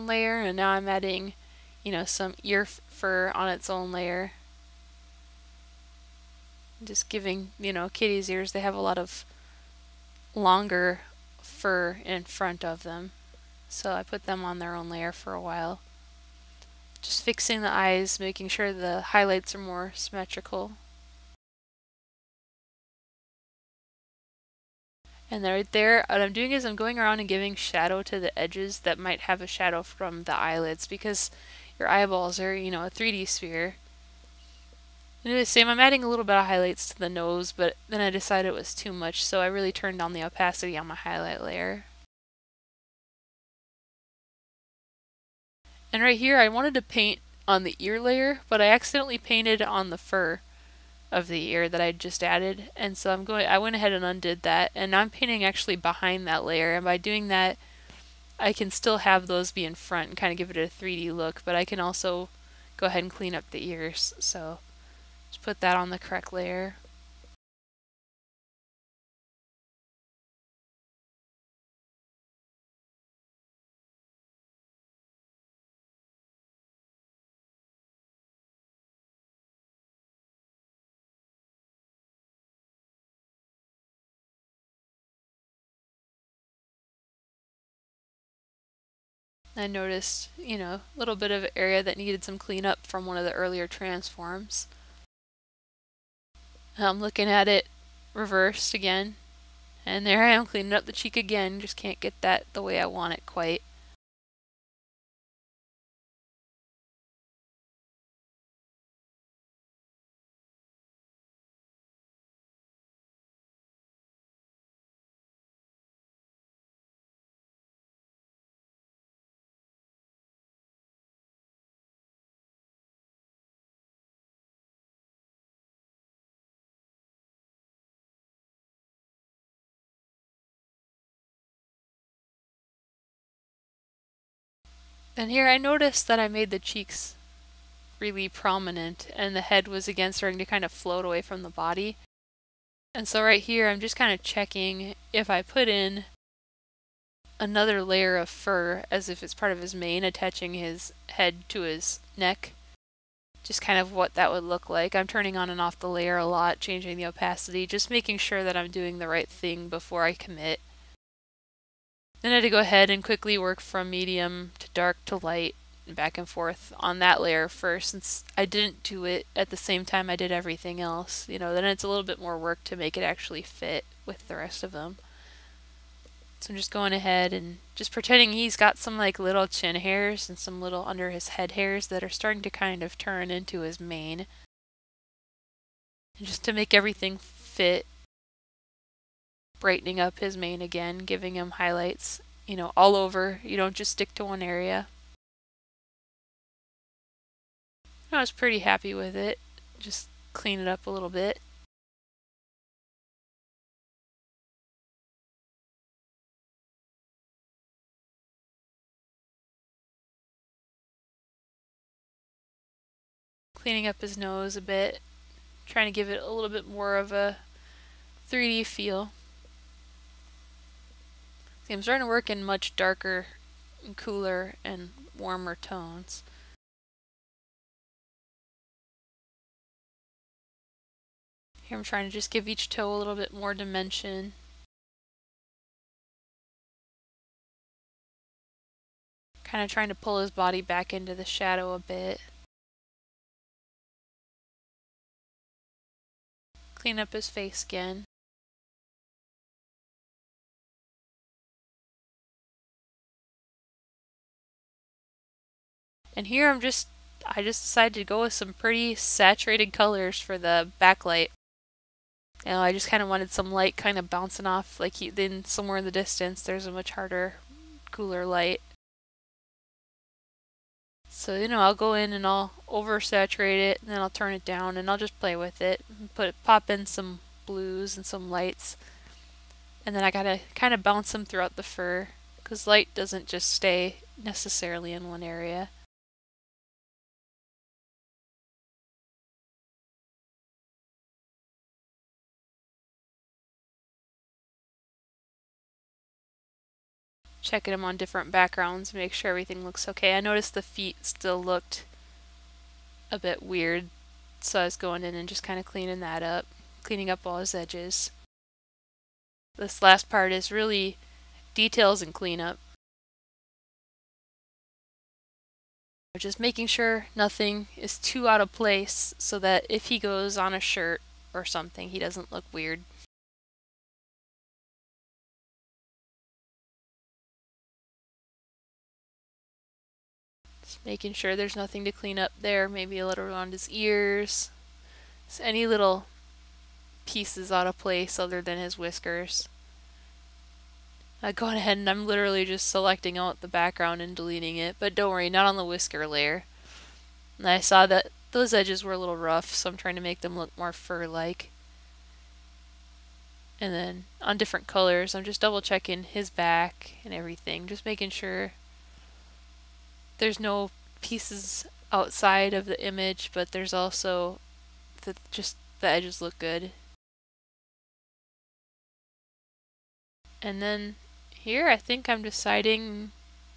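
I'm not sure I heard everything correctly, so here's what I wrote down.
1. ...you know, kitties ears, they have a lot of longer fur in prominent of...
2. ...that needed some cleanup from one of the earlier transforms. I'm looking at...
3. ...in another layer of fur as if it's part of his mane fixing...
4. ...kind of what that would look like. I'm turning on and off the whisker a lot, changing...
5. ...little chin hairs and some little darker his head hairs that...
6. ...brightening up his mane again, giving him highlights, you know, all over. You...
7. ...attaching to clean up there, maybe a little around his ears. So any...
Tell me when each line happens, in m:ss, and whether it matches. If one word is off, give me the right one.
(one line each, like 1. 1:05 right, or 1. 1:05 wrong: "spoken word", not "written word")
1. 0:07 wrong: "front", not "prominent"
2. 1:31 right
3. 2:25 wrong: "attaching", not "fixing"
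4. 2:33 wrong: "layer", not "whisker"
5. 2:59 wrong: "under", not "darker"
6. 3:09 right
7. 5:31 wrong: "nothing", not "attaching".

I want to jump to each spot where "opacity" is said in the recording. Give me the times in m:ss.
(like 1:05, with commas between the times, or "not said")
0:40, 2:37.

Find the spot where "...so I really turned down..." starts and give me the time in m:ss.
0:39.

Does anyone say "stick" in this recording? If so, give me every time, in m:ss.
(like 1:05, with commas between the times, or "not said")
3:13.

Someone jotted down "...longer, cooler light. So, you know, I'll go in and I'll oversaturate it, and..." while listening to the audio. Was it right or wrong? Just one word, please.
wrong.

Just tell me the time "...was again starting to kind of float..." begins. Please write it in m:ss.
2:19.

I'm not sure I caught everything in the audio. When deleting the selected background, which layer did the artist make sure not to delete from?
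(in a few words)
The whisker layer.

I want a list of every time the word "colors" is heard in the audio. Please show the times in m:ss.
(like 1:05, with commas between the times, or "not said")
4:19, 5:54.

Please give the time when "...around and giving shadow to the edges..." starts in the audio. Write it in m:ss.
0:26.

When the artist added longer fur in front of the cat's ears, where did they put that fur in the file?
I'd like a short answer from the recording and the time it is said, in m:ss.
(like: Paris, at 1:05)
On its own layer, at 0:03.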